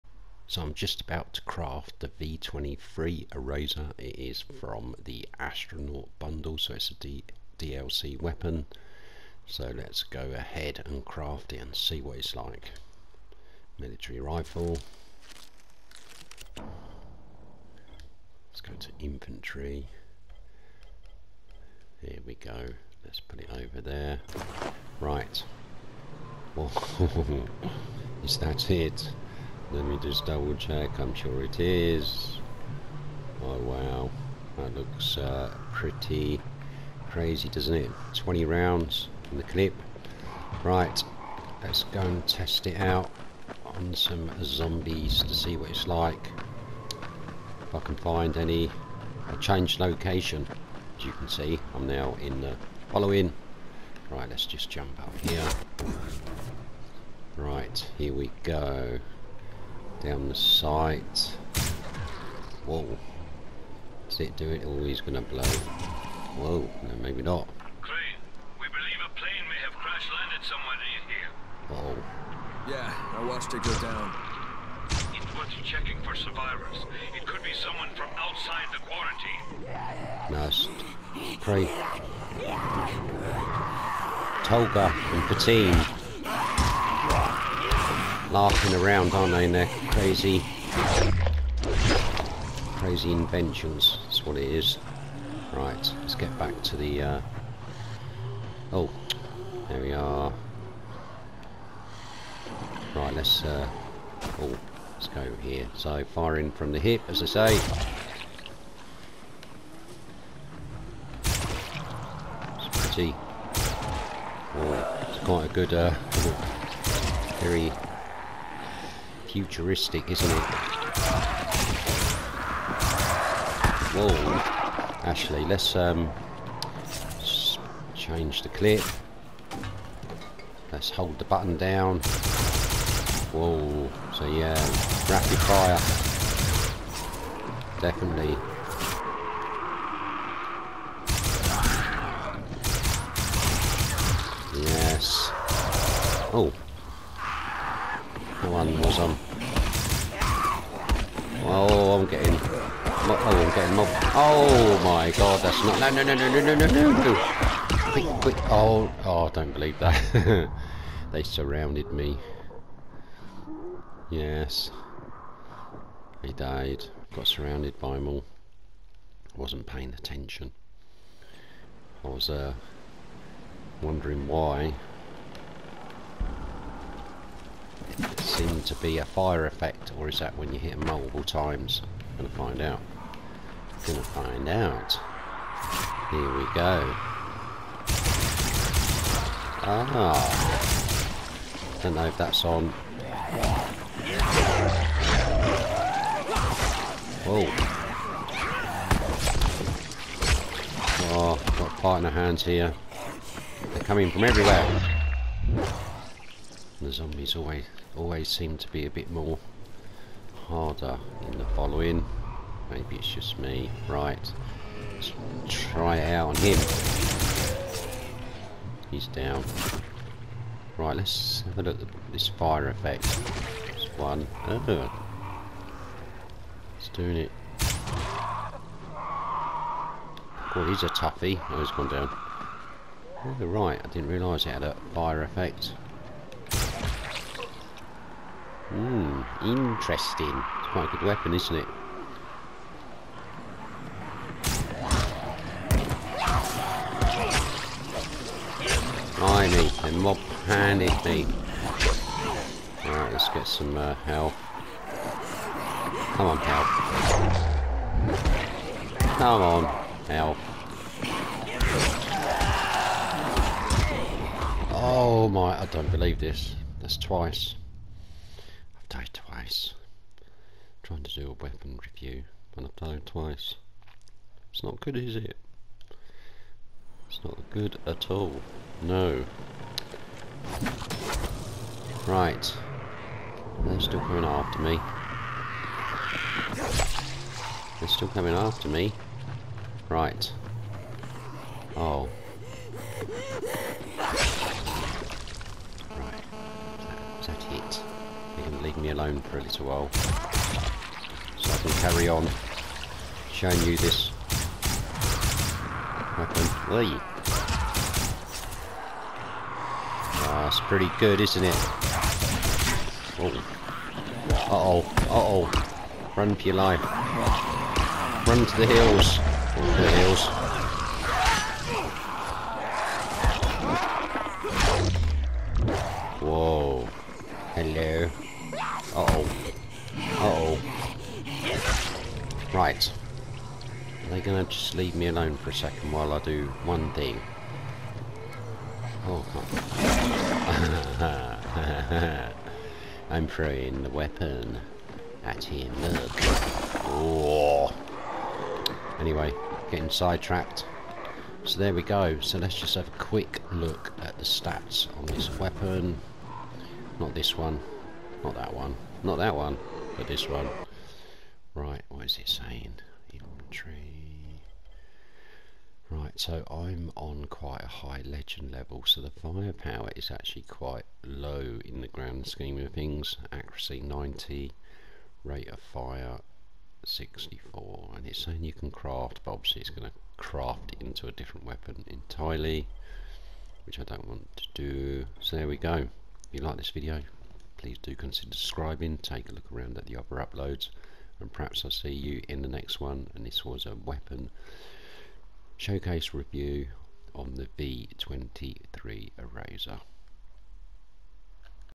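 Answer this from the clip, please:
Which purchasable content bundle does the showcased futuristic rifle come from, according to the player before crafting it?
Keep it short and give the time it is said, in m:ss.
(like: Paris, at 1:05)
Astronaut bundle, at 0:05.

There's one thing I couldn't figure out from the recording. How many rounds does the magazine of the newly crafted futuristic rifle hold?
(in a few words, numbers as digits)
20.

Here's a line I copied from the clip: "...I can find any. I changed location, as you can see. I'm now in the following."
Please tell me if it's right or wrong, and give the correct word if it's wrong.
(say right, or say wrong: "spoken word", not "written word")
right.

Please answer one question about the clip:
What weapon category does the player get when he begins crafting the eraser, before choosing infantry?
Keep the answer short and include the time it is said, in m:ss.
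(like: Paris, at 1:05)
Military rifle, at 0:13.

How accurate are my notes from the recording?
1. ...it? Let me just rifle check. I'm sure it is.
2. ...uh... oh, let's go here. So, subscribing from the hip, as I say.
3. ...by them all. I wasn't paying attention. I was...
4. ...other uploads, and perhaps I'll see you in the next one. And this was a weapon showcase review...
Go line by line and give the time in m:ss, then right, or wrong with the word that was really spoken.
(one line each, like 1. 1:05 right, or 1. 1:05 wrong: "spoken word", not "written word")
1. 0:28 wrong: "double", not "rifle"
2. 1:43 wrong: "firing", not "subscribing"
3. 2:47 right
4. 6:29 right.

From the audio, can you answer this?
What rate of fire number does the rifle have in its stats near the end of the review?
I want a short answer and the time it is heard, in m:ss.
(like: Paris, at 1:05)
64, at 6:15.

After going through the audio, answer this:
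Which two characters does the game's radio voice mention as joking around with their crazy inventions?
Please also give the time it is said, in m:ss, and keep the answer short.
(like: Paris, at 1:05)
Tolga and Fatin, at 1:24.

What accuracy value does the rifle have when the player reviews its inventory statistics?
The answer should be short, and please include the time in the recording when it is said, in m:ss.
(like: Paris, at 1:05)
90, at 6:13.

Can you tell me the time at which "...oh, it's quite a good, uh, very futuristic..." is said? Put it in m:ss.
1:54.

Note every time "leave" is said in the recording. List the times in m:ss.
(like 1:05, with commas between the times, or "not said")
4:58, 5:34.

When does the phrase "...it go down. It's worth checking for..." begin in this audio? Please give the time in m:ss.
1:13.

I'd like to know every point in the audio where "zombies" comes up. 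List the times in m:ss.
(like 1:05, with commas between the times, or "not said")
0:44, 3:26.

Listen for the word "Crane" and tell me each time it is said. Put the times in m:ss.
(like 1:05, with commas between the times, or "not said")
1:07, 1:21.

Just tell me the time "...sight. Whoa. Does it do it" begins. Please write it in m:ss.
1:00.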